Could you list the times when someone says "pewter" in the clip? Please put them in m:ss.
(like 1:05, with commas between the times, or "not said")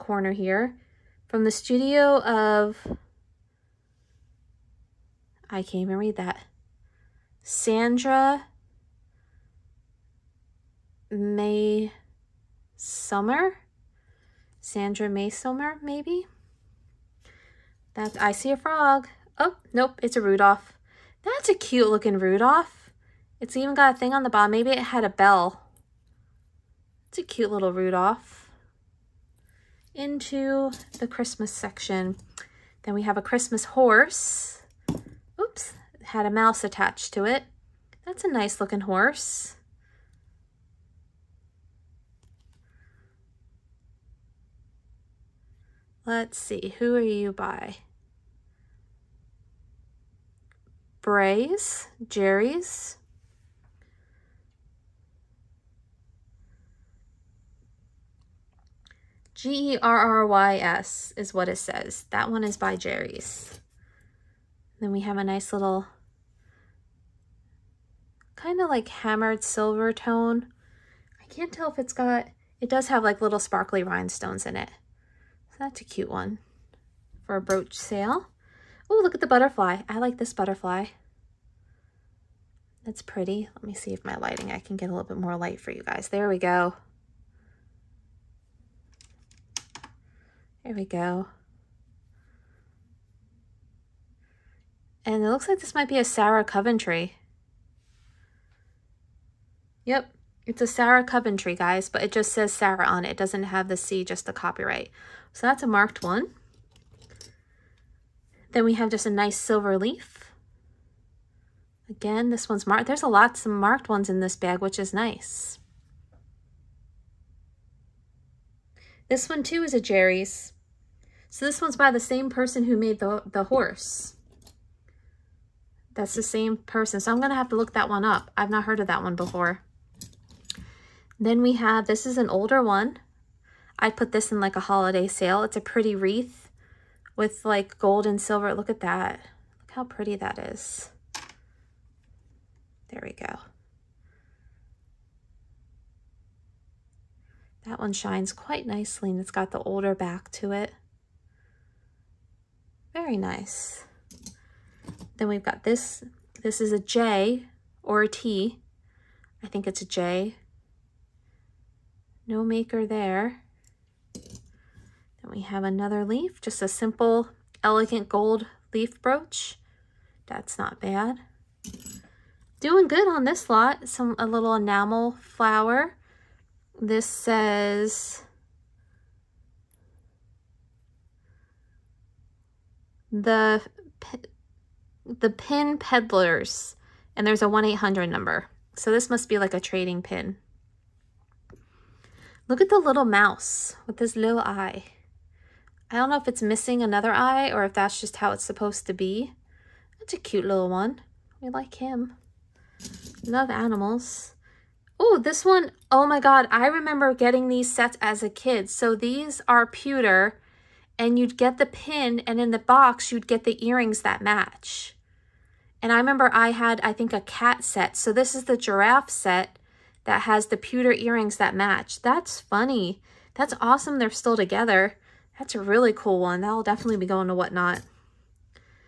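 3:29, 3:40.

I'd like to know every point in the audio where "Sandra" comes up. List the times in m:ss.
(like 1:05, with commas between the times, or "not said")
0:07, 0:14.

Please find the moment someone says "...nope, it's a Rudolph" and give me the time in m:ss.
0:19.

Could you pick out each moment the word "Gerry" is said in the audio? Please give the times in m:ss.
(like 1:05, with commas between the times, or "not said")
0:52, 1:02, 1:59.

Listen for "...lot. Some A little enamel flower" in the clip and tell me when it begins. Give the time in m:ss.
2:53.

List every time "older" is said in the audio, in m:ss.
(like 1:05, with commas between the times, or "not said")
2:12, 2:29.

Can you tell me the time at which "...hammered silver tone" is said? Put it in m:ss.
1:08.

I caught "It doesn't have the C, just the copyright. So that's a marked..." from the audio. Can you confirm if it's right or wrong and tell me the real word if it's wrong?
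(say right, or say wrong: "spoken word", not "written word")
right.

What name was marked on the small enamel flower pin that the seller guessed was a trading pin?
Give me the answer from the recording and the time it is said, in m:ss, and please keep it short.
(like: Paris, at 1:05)
The Pin Peddlers, at 3:03.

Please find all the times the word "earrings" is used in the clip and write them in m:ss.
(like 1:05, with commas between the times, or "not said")
3:33, 3:40.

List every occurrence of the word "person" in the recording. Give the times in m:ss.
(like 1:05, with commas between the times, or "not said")
2:02, 2:06.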